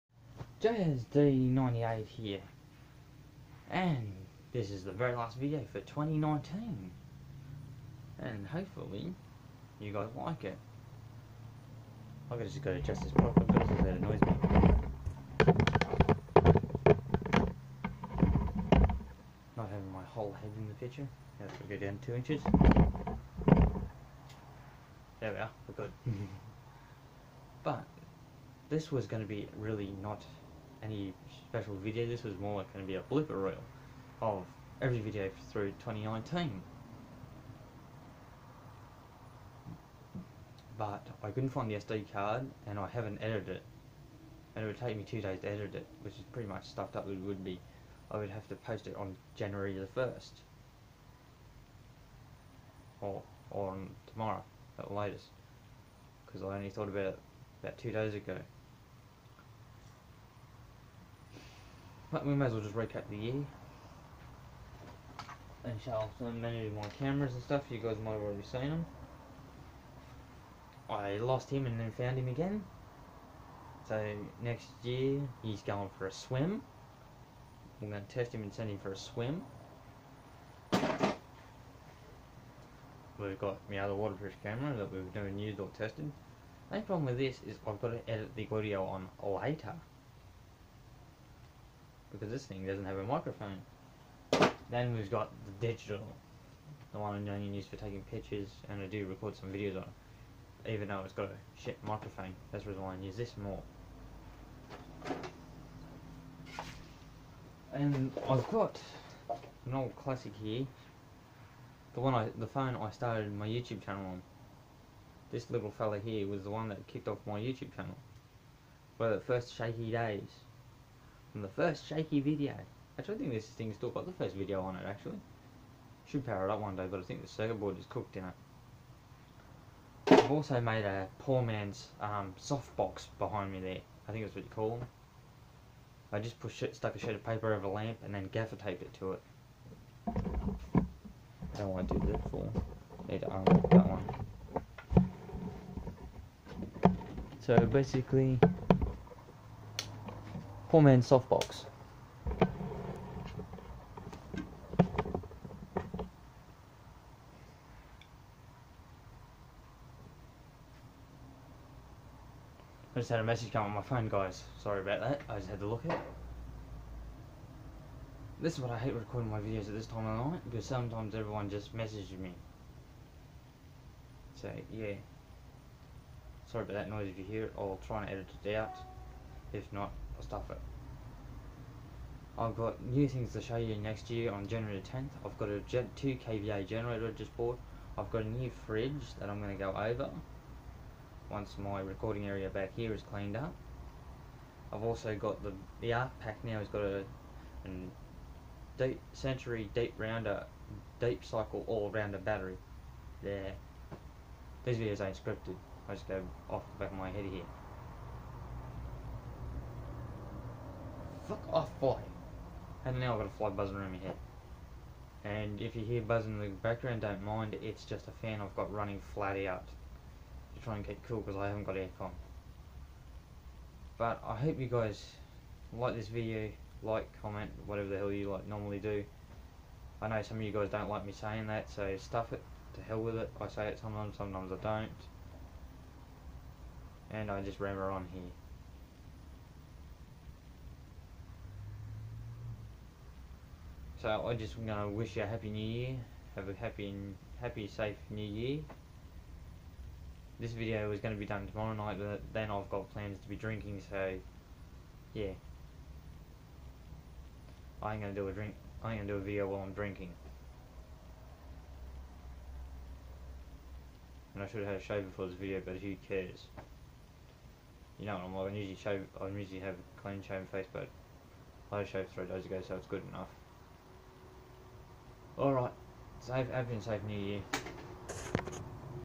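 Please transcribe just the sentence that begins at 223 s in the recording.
But I hope you guys like this video, like, comment, whatever the hell you like normally do.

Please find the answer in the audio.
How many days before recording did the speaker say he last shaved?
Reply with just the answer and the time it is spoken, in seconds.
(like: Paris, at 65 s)
3, at 272 s.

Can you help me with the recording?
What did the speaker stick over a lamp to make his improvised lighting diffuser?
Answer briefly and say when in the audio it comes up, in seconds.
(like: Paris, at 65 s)
A sheet of paper, at 136 s.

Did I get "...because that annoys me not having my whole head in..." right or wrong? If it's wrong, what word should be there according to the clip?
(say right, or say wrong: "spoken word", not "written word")
right.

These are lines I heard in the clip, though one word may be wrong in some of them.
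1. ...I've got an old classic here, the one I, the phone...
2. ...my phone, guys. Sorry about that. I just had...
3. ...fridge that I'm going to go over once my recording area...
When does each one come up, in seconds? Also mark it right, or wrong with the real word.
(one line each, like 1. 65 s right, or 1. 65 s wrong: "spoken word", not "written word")
1. 108 s right
2. 163 s right
3. 188 s right.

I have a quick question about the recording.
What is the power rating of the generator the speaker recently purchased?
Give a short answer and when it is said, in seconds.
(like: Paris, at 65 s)
2 kVA, at 185 s.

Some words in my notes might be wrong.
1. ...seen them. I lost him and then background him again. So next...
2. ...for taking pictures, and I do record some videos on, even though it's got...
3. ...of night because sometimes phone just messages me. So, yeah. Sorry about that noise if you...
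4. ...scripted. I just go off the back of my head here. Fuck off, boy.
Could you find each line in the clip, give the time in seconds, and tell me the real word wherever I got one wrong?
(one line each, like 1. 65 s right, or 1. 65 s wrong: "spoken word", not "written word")
1. 68 s wrong: "found", not "background"
2. 97 s right
3. 170 s wrong: "everyone", not "phone"
4. 205 s right.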